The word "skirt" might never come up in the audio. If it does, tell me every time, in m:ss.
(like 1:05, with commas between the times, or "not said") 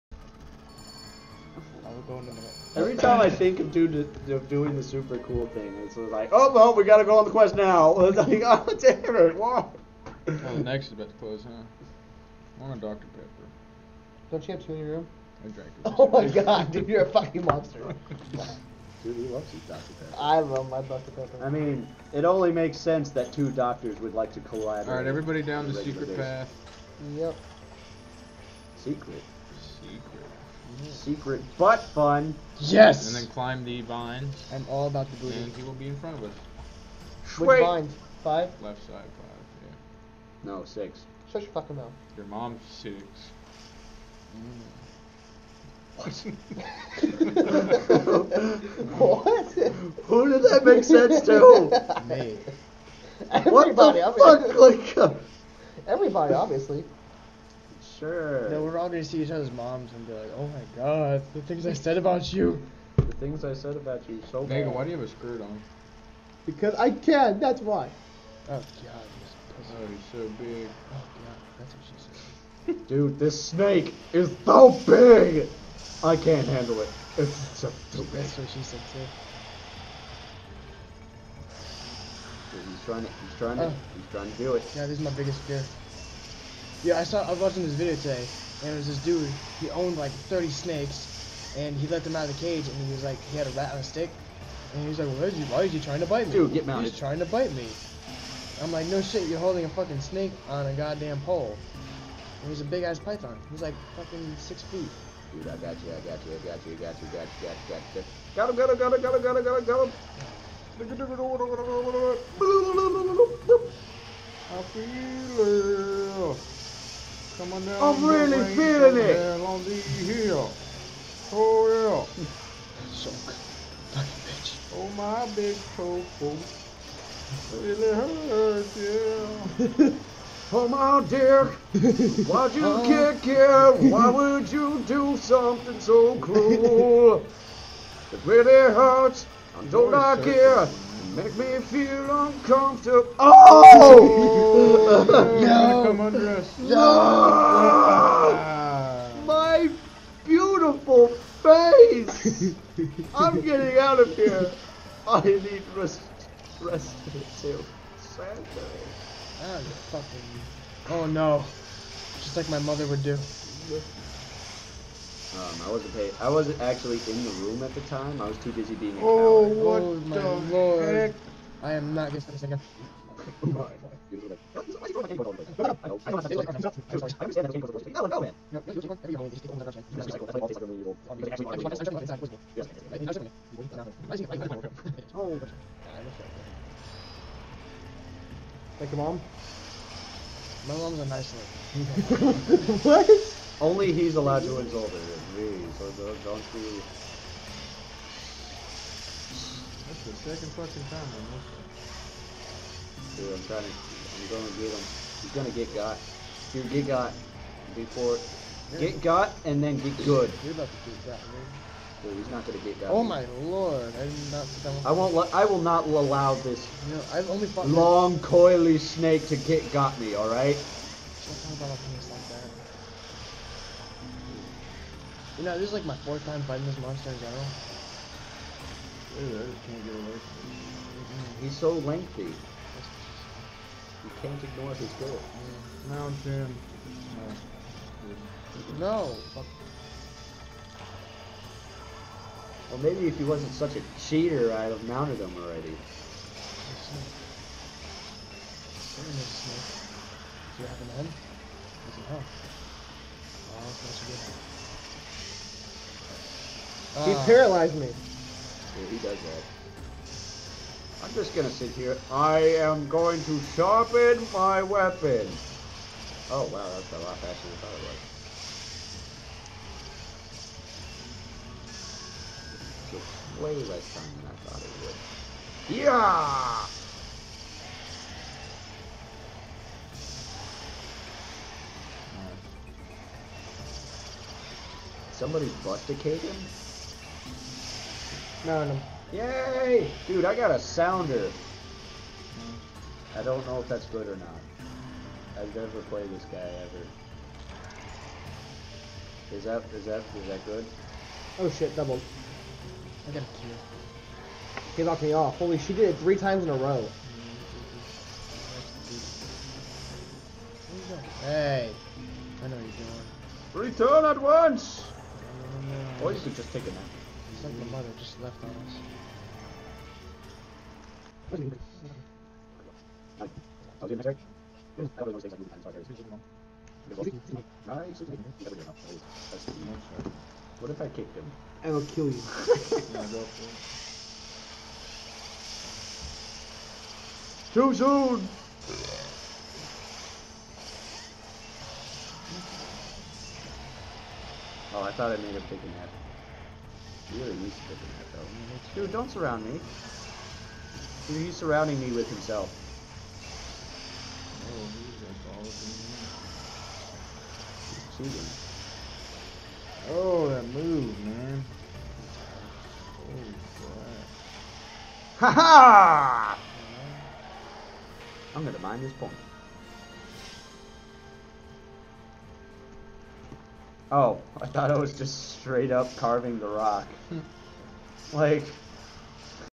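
1:05.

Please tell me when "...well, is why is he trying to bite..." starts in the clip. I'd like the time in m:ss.
1:35.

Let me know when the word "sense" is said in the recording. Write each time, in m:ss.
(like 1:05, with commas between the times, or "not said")
0:22, 0:50.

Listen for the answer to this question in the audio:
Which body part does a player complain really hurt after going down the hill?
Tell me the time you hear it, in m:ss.
2:05.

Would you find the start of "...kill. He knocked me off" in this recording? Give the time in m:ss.
5:03.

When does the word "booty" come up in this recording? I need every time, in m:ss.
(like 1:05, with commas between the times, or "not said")
0:35.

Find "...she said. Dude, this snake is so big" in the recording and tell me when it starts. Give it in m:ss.
1:11.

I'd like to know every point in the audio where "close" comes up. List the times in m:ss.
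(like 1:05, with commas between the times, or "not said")
0:11.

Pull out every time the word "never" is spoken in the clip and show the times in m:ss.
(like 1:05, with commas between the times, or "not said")
4:55.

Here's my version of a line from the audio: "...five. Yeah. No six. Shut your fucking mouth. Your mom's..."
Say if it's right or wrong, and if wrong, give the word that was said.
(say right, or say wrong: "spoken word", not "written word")
right.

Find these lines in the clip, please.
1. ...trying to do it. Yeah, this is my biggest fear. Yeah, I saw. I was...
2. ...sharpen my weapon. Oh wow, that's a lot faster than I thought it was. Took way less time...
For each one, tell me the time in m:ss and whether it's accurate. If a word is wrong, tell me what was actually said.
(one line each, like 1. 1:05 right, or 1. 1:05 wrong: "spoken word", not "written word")
1. 1:24 right
2. 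4:23 right.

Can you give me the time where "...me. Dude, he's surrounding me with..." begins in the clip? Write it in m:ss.
5:49.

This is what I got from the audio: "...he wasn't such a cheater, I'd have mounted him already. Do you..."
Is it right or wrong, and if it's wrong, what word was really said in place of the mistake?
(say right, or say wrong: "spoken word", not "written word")
right.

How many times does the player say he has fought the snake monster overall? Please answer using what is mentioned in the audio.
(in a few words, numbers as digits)
4th time.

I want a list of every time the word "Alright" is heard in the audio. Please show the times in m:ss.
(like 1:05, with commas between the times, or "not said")
0:24.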